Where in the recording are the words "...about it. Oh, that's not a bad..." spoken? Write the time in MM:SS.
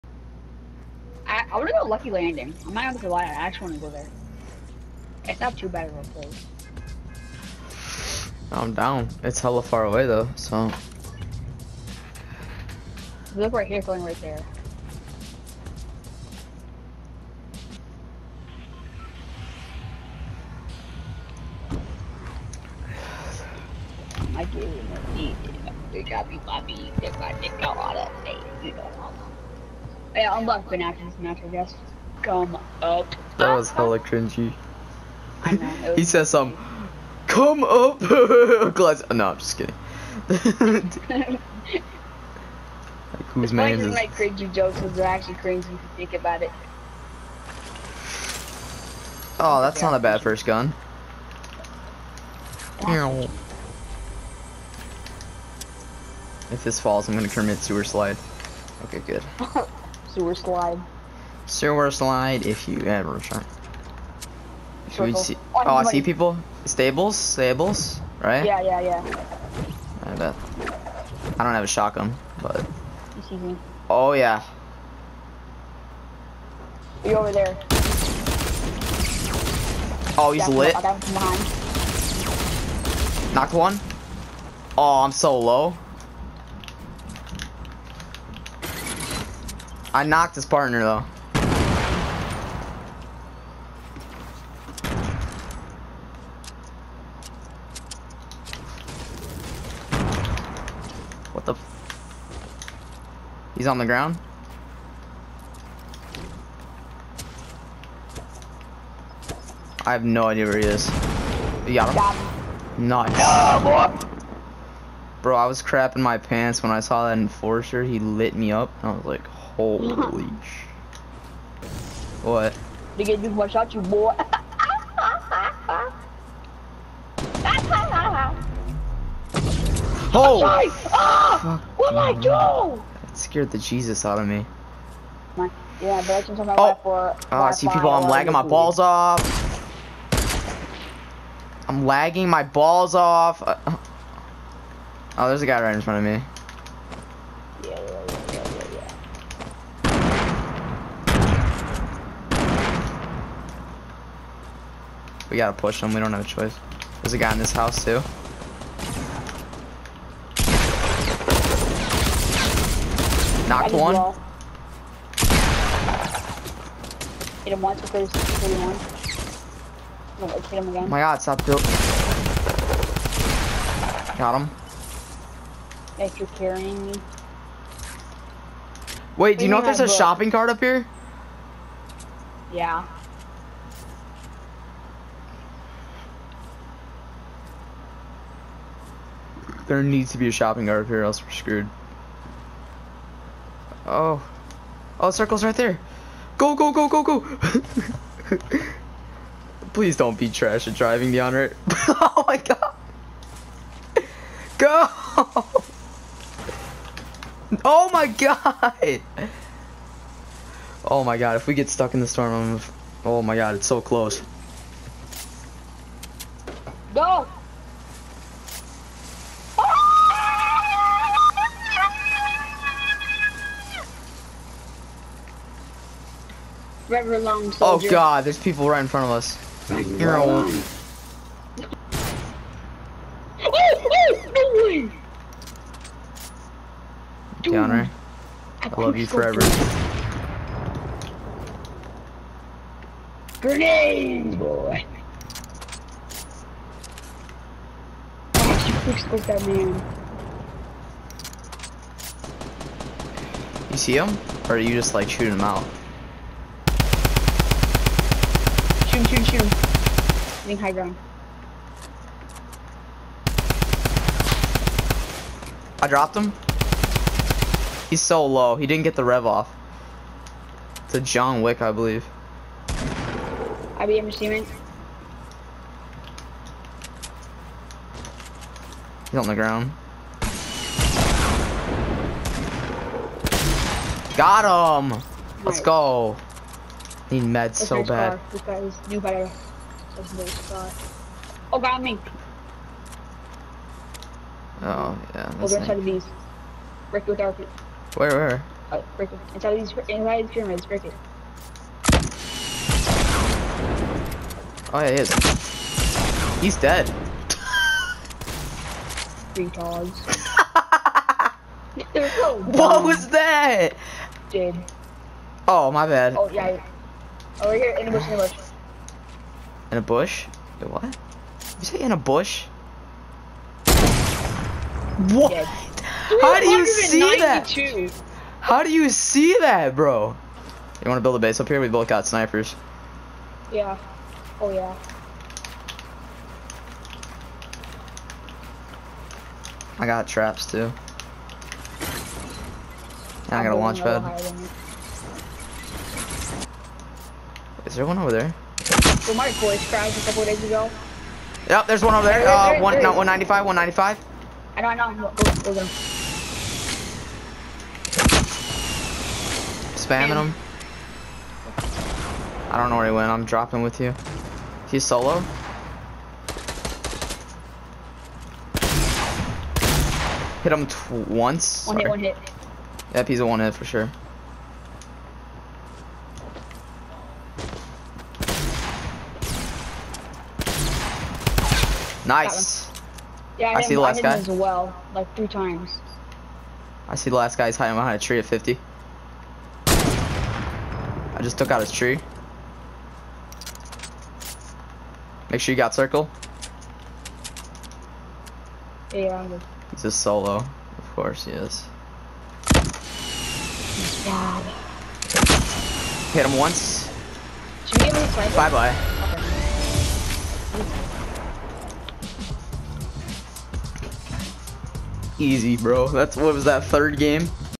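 00:46.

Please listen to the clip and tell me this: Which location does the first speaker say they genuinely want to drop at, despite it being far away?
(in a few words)
Lucky Landing.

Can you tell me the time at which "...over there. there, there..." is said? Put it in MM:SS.
05:51.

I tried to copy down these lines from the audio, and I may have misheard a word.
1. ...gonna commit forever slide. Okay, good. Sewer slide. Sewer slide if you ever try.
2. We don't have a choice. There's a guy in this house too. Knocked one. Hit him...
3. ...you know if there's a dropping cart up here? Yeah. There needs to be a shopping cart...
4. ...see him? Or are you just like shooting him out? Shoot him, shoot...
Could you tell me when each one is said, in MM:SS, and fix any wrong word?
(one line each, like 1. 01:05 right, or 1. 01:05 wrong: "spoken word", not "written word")
1. 00:57 wrong: "sewer", not "forever"
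2. 02:35 right
3. 02:59 wrong: "shopping", not "dropping"
4. 04:13 right.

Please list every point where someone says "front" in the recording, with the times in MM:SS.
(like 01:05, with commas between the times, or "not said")
02:25, 03:48.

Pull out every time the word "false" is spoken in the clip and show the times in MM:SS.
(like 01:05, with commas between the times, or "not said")
not said.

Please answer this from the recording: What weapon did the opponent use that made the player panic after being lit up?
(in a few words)
enforcer.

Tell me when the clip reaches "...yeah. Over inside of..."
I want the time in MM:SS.
04:55.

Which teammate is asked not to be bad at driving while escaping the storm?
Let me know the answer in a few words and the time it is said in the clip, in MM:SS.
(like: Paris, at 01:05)
DeAndre, at 03:21.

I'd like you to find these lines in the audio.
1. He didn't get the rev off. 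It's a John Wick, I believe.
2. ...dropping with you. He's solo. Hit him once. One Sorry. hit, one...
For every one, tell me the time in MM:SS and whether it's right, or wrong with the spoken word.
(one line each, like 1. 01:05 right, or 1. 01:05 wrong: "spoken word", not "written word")
1. 04:28 right
2. 06:03 right.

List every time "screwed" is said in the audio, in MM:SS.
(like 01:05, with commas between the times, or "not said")
03:11.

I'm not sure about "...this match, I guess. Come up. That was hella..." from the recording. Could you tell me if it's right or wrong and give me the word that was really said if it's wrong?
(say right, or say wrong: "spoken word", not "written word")
right.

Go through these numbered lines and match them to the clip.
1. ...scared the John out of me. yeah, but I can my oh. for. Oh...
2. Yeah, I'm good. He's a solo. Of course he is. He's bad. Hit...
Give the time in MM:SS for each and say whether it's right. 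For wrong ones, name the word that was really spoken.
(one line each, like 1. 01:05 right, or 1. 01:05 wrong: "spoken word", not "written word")
1. 02:13 wrong: "Jesus", not "John"
2. 06:38 right.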